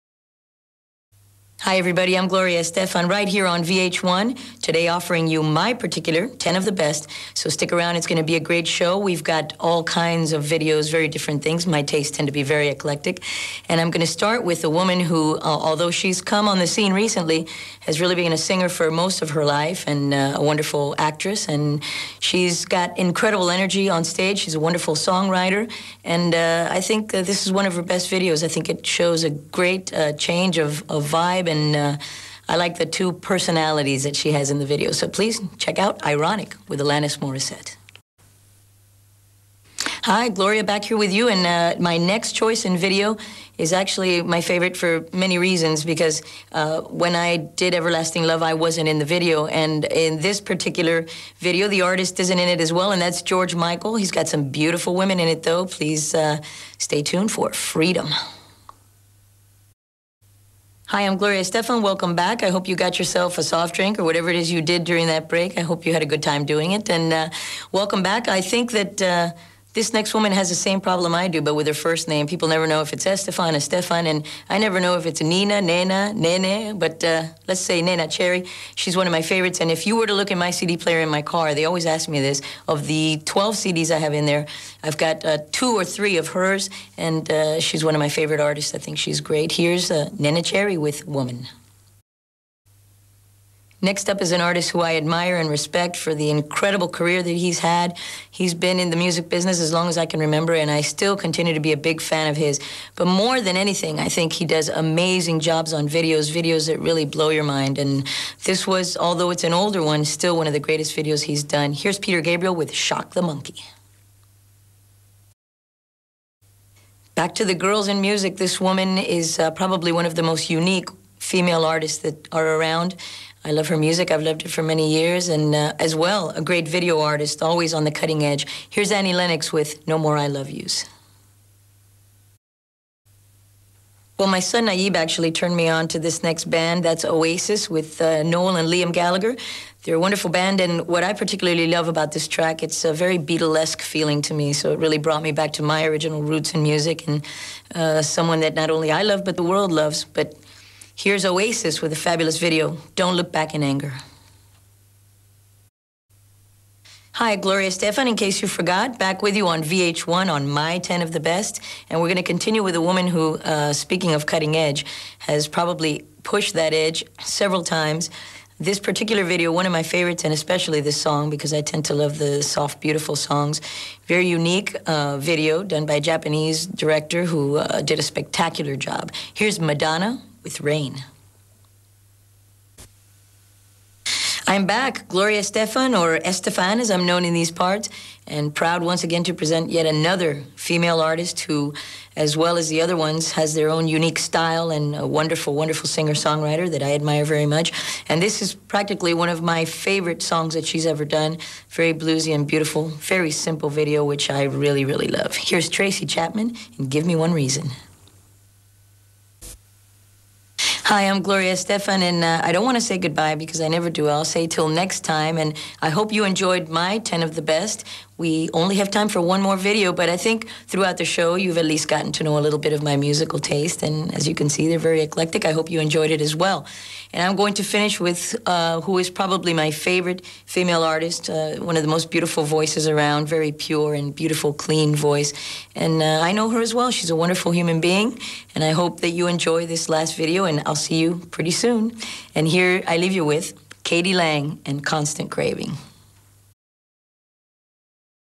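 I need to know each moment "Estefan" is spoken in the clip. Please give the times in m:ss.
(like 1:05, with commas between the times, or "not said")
1:13, 3:06.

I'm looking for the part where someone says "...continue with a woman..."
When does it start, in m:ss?
2:42.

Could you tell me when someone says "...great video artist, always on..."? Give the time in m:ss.
2:06.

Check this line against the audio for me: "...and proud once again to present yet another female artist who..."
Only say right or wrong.
right.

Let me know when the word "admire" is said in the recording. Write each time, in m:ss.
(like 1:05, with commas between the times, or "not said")
1:34, 3:16.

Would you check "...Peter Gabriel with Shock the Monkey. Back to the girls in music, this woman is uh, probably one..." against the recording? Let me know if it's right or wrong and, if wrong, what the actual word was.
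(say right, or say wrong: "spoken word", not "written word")
right.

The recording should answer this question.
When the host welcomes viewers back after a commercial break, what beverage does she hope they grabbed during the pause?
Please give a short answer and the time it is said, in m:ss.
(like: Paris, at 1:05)
soft drink, at 1:03.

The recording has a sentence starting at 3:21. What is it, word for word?
Very bluesy and beautiful, very simple video, which I really, really love.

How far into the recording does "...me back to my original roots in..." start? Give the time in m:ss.
2:25.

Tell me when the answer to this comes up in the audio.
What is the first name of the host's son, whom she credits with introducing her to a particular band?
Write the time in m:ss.
2:14.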